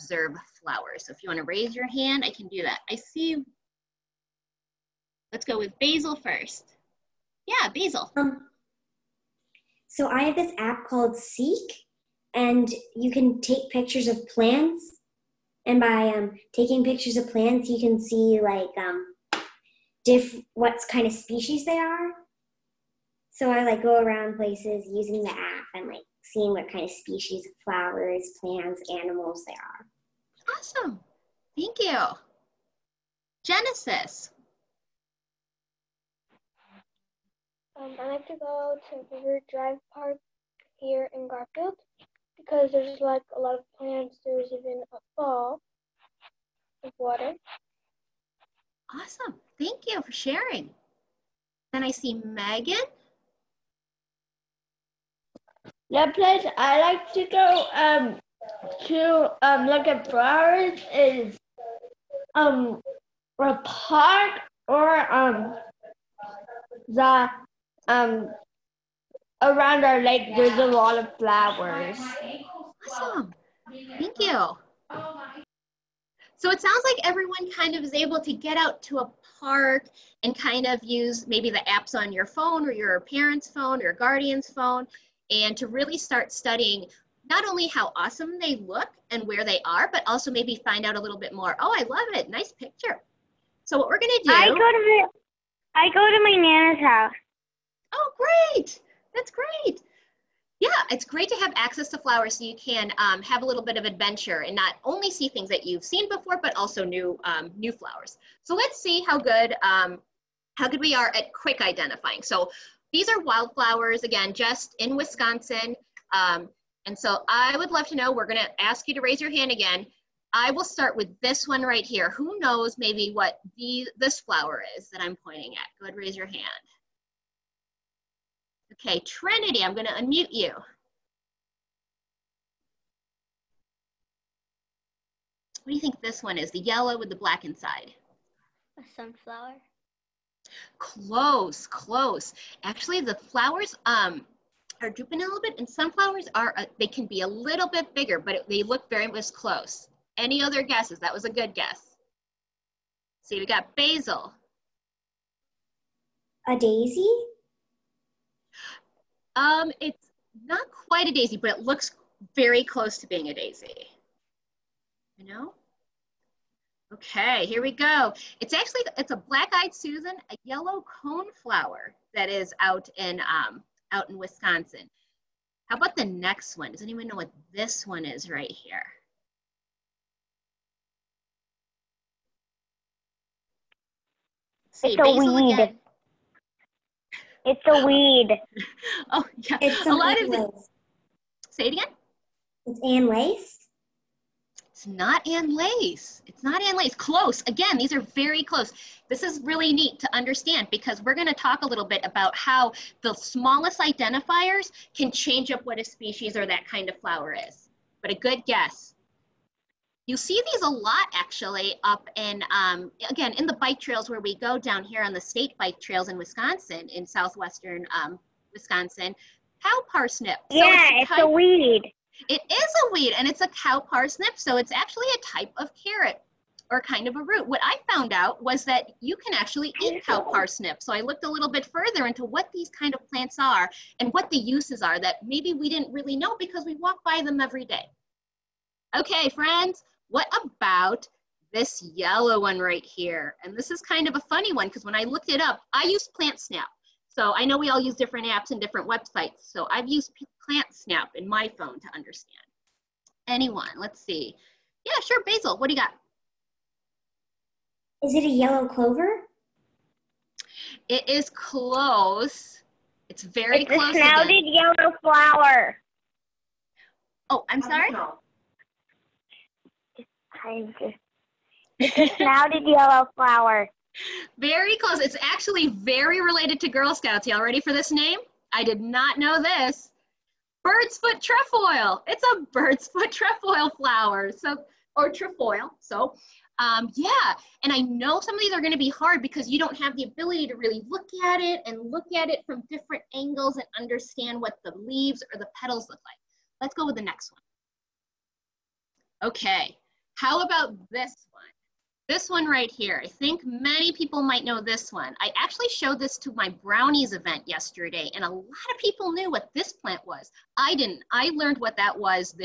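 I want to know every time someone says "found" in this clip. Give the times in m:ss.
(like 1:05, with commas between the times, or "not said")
3:47.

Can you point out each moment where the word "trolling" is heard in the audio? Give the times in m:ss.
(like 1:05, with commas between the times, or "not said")
not said.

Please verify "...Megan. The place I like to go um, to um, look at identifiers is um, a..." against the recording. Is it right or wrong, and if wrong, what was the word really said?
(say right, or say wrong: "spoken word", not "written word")
wrong: "flowers", not "identifiers".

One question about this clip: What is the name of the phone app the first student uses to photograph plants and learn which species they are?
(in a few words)
Seek.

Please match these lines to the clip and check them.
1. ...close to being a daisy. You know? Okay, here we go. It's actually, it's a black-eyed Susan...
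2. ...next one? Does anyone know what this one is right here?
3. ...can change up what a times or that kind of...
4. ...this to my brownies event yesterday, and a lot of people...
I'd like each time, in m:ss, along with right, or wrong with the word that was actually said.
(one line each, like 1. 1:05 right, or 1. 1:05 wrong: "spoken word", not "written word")
1. 2:42 right
2. 2:56 right
3. 3:24 wrong: "species", not "times"
4. 5:05 right.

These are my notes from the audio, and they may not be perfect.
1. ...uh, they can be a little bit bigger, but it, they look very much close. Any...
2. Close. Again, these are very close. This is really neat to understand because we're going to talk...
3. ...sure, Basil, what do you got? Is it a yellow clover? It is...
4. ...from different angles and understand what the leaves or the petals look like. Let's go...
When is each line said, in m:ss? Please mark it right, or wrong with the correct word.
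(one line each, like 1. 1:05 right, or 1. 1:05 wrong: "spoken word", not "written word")
1. 2:26 right
2. 3:16 right
3. 4:15 right
4. 4:52 right.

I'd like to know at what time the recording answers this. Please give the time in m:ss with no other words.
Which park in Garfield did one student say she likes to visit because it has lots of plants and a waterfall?
0:39.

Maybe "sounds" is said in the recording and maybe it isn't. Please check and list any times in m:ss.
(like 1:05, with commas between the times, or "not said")
1:16.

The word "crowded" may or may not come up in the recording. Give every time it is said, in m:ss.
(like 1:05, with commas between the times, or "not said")
4:24.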